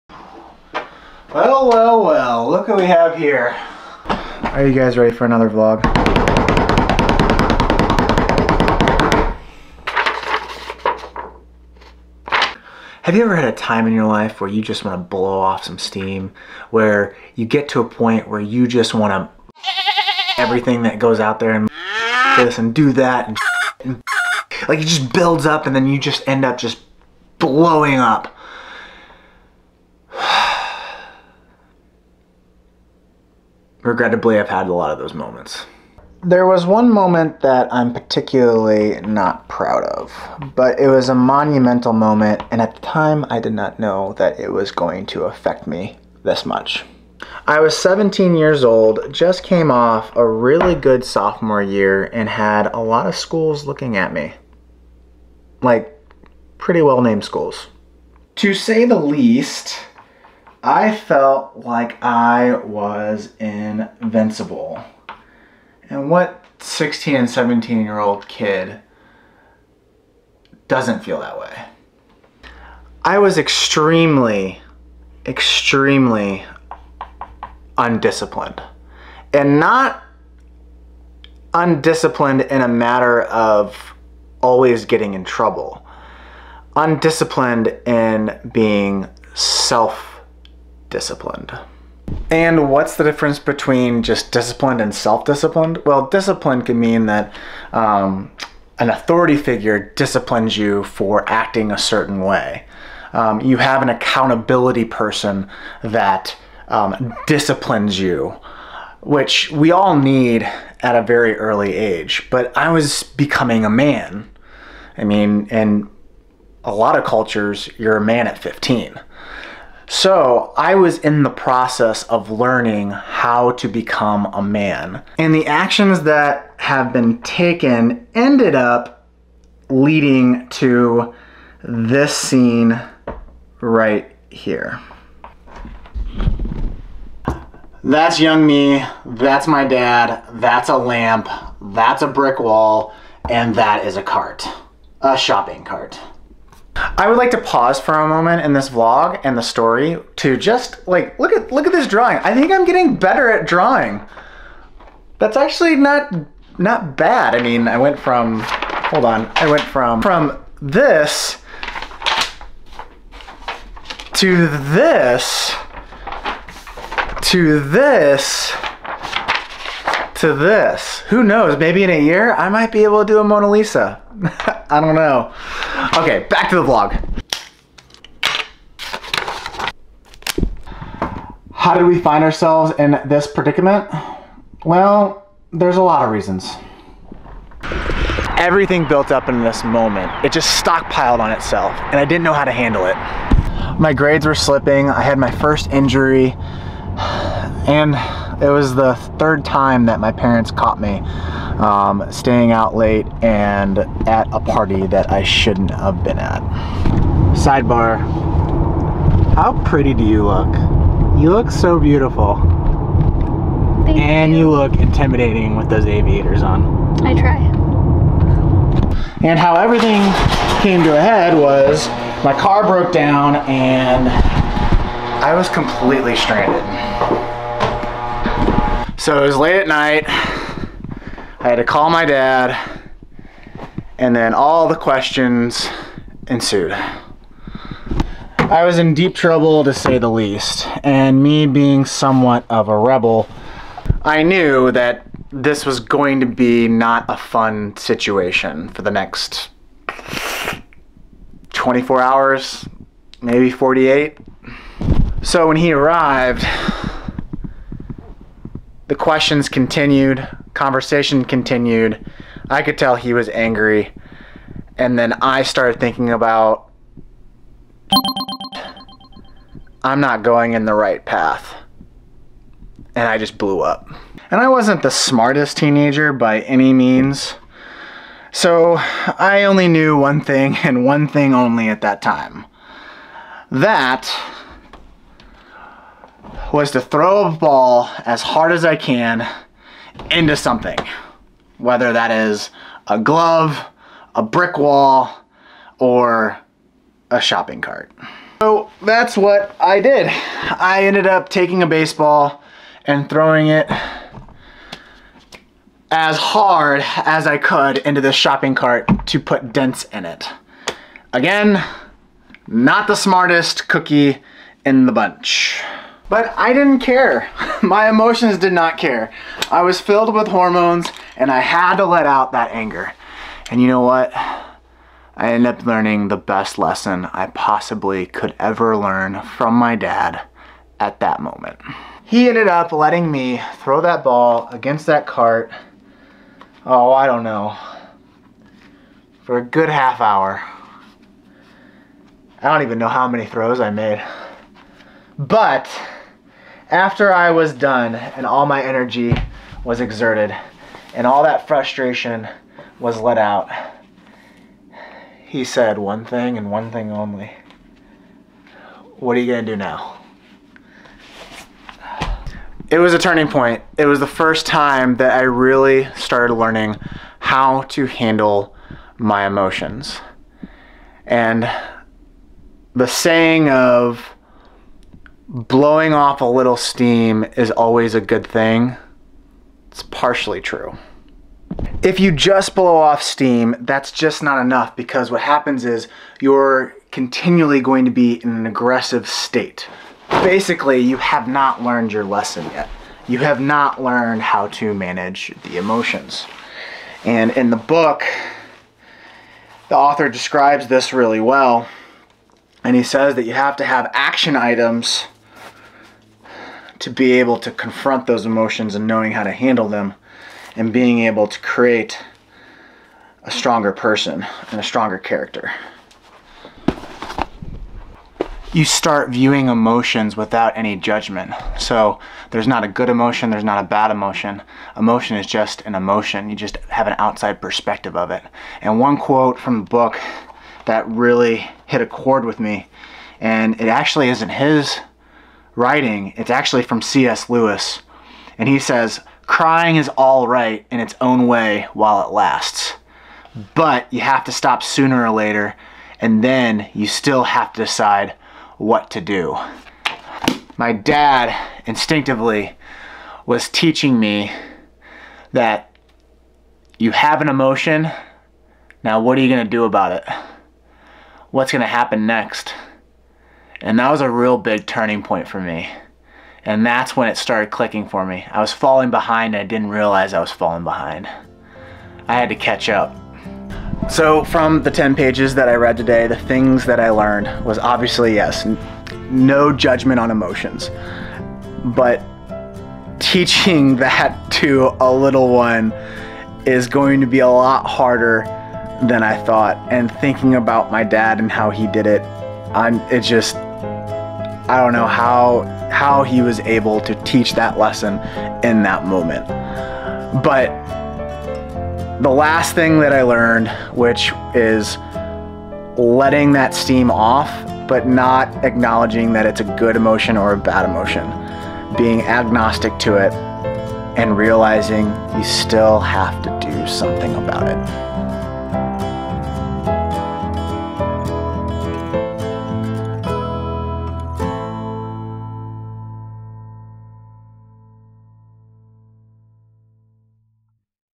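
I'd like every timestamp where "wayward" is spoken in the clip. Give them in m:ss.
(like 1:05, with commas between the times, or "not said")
not said.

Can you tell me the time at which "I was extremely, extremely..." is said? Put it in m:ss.
1:13.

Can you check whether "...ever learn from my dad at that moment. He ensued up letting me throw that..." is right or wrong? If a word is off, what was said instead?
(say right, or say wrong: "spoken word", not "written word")
wrong: "ended", not "ensued".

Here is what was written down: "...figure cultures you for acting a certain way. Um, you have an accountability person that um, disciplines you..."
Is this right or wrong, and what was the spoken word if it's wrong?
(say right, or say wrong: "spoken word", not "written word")
wrong: "disciplines", not "cultures".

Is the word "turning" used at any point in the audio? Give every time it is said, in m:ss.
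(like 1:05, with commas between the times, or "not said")
6:02, 7:44.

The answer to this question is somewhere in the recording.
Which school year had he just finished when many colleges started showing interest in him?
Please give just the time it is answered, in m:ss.
0:51.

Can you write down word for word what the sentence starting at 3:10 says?
It just stockpiled on itself, and I didn't know how to handle it.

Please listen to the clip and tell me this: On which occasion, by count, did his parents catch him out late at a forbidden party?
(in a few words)
third time.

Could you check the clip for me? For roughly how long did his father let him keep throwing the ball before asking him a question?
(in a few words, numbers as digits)
half hour.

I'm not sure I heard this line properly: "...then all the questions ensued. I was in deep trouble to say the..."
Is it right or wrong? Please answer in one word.
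right.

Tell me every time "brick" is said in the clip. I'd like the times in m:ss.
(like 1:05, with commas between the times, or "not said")
2:22, 4:54.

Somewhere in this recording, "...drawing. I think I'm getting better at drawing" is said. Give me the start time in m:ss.
2:31.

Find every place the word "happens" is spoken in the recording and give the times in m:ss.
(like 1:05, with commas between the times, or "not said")
6:25, 7:41.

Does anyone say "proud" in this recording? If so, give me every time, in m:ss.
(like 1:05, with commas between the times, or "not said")
0:39.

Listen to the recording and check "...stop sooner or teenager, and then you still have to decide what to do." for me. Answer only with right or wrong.
wrong.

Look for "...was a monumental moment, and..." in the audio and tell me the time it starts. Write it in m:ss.
0:40.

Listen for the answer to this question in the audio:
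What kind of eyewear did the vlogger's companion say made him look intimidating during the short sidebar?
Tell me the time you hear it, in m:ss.
3:35.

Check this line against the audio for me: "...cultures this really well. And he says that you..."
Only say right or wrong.
wrong.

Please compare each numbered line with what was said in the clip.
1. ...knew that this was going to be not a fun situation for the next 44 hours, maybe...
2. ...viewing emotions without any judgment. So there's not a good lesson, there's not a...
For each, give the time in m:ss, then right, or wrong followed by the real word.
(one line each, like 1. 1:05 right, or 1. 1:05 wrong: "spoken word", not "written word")
1. 4:04 wrong: "24", not "44"
2. 6:59 wrong: "emotion", not "lesson".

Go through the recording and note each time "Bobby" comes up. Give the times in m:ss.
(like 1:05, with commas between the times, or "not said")
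not said.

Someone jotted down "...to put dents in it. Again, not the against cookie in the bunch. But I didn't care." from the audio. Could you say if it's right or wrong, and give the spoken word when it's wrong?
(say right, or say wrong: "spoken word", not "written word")
wrong: "smartest", not "against".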